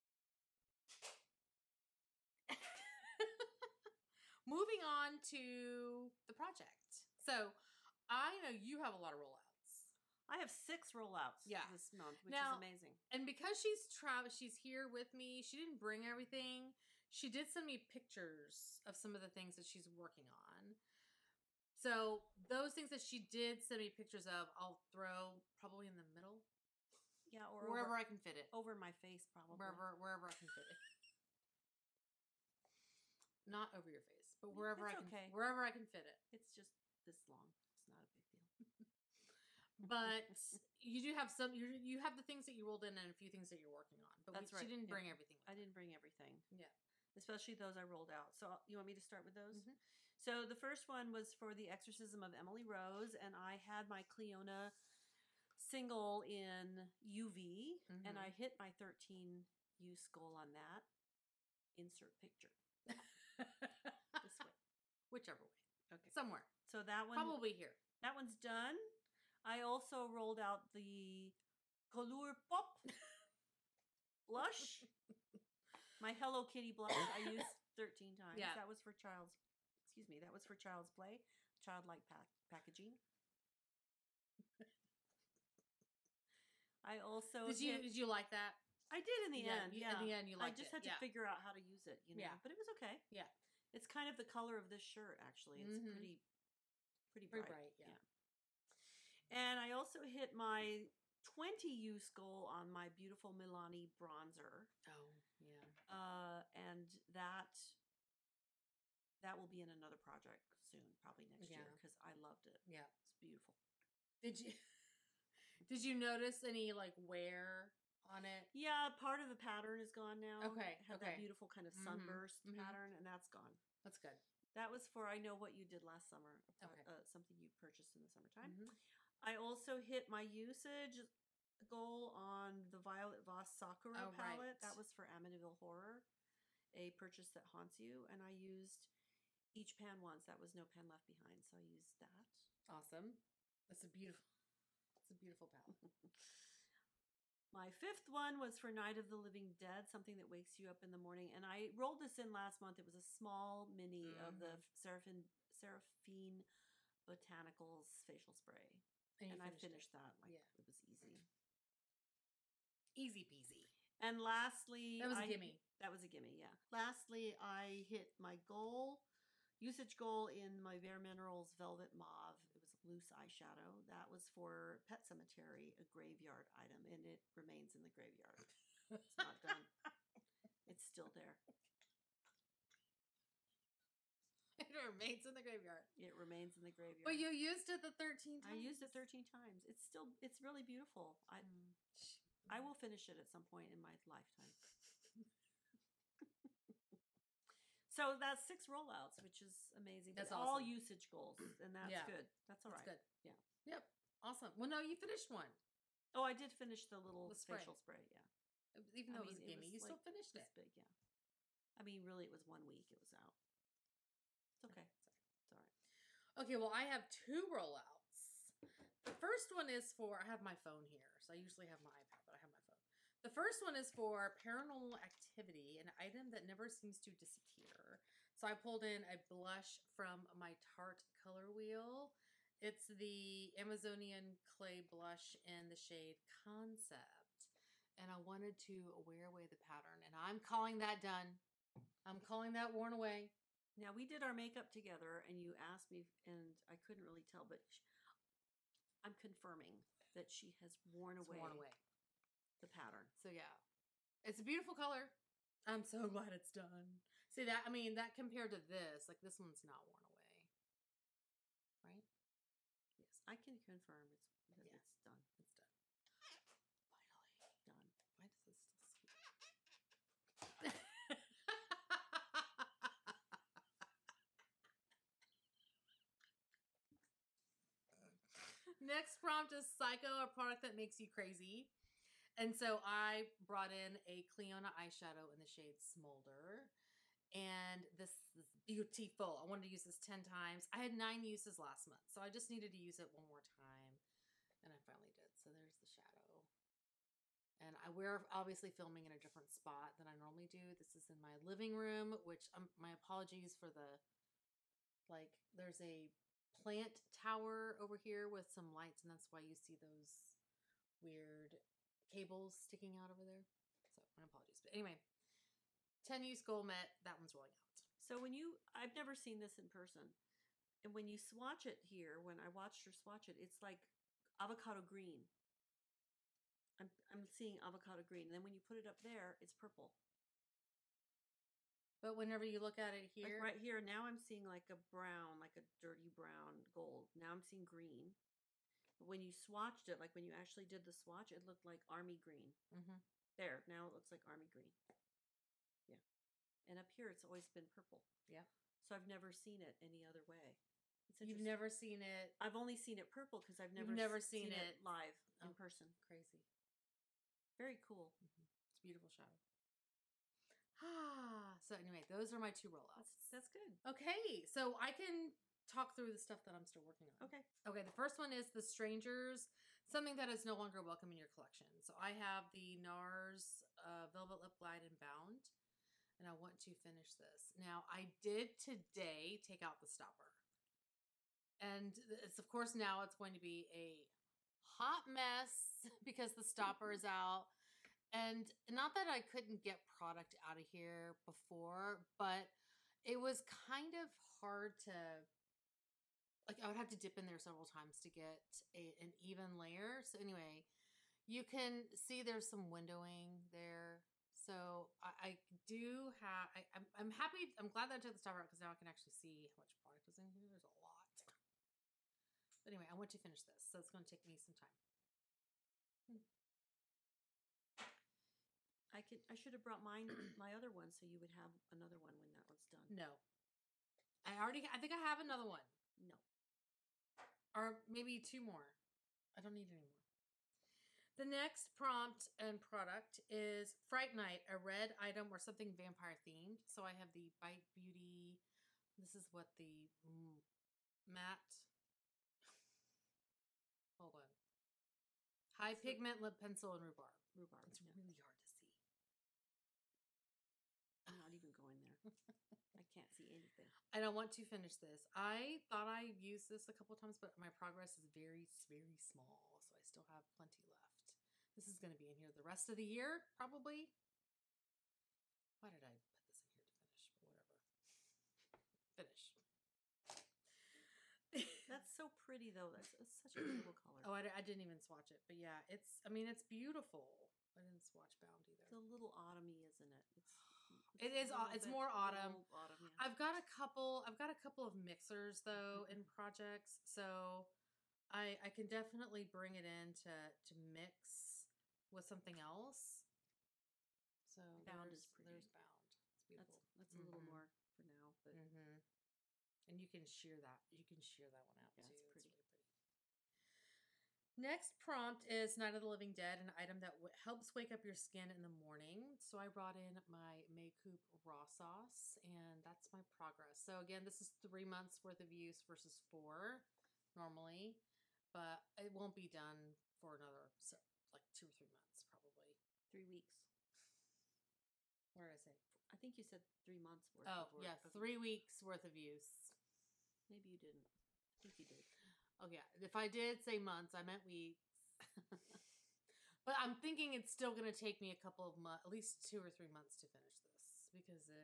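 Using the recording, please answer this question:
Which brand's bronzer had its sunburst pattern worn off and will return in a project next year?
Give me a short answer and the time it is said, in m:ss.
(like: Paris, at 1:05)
Milani, at 1:43.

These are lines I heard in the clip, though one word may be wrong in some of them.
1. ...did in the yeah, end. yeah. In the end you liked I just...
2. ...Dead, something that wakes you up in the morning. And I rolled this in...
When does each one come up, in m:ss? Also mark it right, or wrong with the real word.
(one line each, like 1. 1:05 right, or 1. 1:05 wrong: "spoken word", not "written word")
1. 1:28 right
2. 2:29 right.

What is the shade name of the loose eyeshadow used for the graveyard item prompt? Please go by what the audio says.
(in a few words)
Velvet Mauve.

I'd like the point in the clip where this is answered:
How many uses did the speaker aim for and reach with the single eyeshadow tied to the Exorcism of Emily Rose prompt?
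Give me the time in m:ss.
0:58.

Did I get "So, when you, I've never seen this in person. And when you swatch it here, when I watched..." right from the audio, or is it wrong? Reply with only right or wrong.
right.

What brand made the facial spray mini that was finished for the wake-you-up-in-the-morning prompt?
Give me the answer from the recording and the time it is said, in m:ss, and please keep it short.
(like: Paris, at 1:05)
Seraphine Botanicals, at 2:35.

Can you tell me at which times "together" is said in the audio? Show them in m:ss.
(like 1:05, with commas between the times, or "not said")
4:04.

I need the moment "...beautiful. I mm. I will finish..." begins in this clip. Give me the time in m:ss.
3:10.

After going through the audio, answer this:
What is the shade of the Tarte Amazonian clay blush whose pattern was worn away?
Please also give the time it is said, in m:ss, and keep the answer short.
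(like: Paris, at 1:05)
Concept, at 3:56.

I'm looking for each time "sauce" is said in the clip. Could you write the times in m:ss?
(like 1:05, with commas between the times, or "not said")
8:31.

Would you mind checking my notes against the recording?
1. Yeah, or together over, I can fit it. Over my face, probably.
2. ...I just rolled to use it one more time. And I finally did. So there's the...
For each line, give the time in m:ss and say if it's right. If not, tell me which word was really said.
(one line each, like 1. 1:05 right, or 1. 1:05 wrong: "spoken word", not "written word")
1. 0:27 wrong: "wherever", not "together"
2. 4:52 wrong: "needed", not "rolled".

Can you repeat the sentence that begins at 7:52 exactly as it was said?
That's, that's such a beautiful color.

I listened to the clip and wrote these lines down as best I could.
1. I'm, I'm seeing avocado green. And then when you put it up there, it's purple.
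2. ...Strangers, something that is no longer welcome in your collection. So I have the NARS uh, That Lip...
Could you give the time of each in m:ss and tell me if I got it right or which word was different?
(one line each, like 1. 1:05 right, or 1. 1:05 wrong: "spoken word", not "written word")
1. 5:26 right
2. 6:08 wrong: "Velvet", not "That".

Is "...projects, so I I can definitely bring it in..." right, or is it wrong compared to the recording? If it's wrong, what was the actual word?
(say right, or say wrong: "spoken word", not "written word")
right.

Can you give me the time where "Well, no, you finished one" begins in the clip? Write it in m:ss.
3:24.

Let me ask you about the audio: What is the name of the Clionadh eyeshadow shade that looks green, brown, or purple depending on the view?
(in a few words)
Smolder.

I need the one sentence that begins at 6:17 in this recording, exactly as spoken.
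Now, I did today take out the stopper.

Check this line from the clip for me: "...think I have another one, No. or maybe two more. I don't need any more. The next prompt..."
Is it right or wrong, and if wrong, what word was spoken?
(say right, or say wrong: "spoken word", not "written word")
right.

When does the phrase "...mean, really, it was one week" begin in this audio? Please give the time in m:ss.
3:31.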